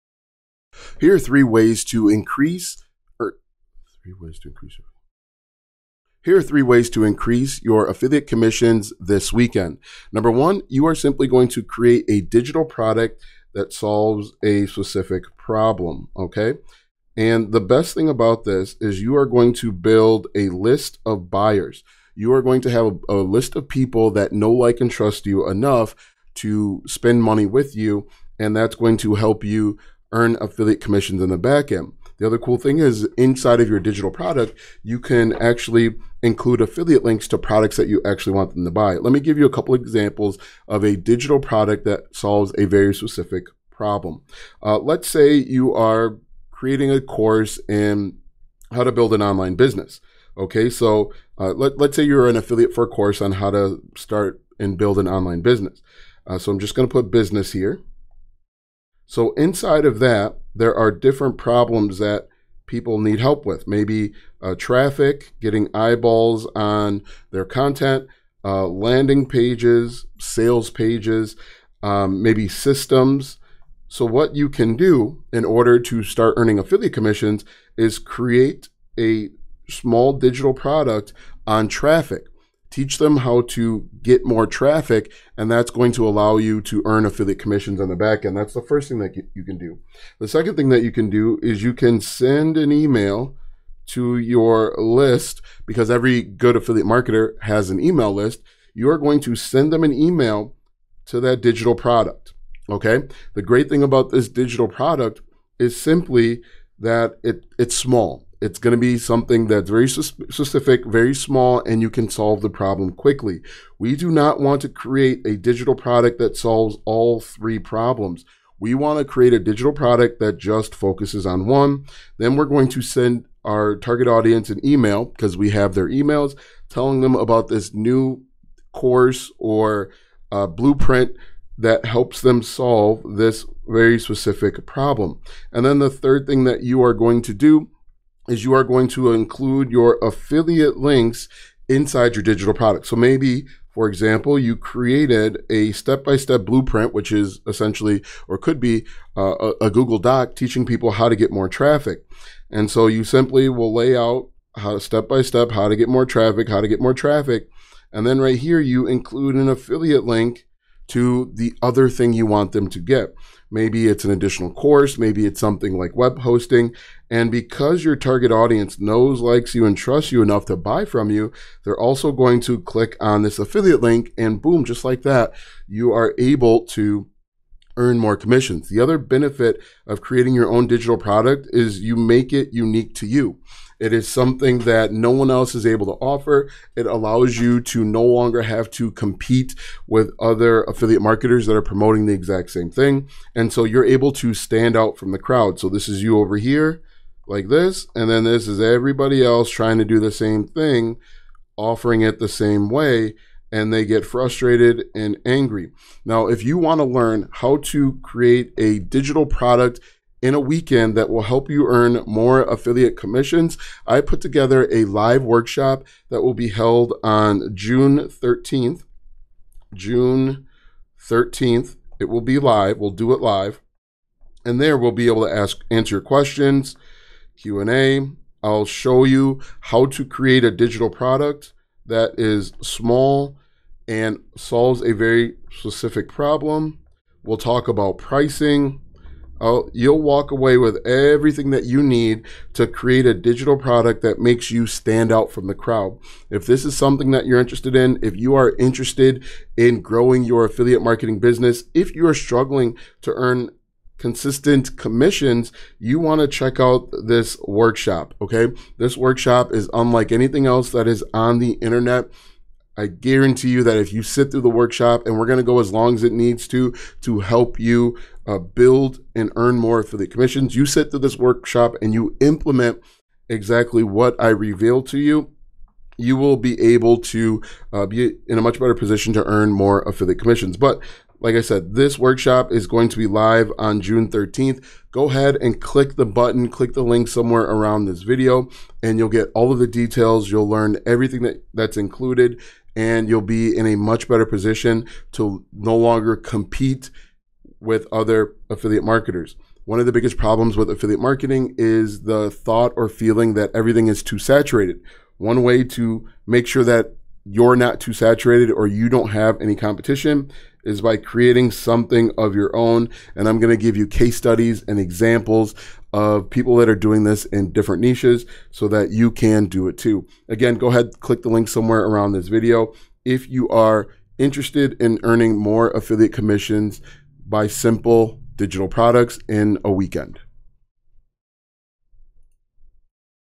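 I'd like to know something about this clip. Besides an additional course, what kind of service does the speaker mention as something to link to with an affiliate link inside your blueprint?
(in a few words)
web hosting.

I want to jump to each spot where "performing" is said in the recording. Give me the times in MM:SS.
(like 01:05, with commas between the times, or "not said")
not said.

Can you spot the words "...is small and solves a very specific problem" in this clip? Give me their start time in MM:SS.
03:52.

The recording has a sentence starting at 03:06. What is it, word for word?
It allows you to no longer have to compete with other affiliate marketers that are promoting the exact same thing.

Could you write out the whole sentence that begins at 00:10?
Number one, you are simply going to create a digital product that solves a specific problem.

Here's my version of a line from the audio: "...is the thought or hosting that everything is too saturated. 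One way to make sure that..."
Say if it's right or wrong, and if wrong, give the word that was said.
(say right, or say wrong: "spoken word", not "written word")
wrong: "feeling", not "hosting".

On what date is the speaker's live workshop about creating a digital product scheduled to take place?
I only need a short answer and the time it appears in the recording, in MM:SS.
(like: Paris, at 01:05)
June 13th, at 03:39.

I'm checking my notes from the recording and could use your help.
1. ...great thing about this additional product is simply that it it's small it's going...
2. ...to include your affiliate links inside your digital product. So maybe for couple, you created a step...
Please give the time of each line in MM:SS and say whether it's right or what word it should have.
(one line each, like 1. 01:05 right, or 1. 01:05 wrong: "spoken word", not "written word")
1. 01:43 wrong: "digital", not "additional"
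2. 02:18 wrong: "example", not "couple".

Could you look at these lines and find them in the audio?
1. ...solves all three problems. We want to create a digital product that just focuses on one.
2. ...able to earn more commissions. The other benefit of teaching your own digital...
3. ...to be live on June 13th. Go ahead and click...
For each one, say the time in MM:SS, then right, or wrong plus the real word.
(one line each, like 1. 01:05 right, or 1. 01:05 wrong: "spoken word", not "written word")
1. 01:56 right
2. 02:56 wrong: "creating", not "teaching"
3. 04:42 right.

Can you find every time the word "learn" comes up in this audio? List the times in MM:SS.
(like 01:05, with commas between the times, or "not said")
03:26, 04:50.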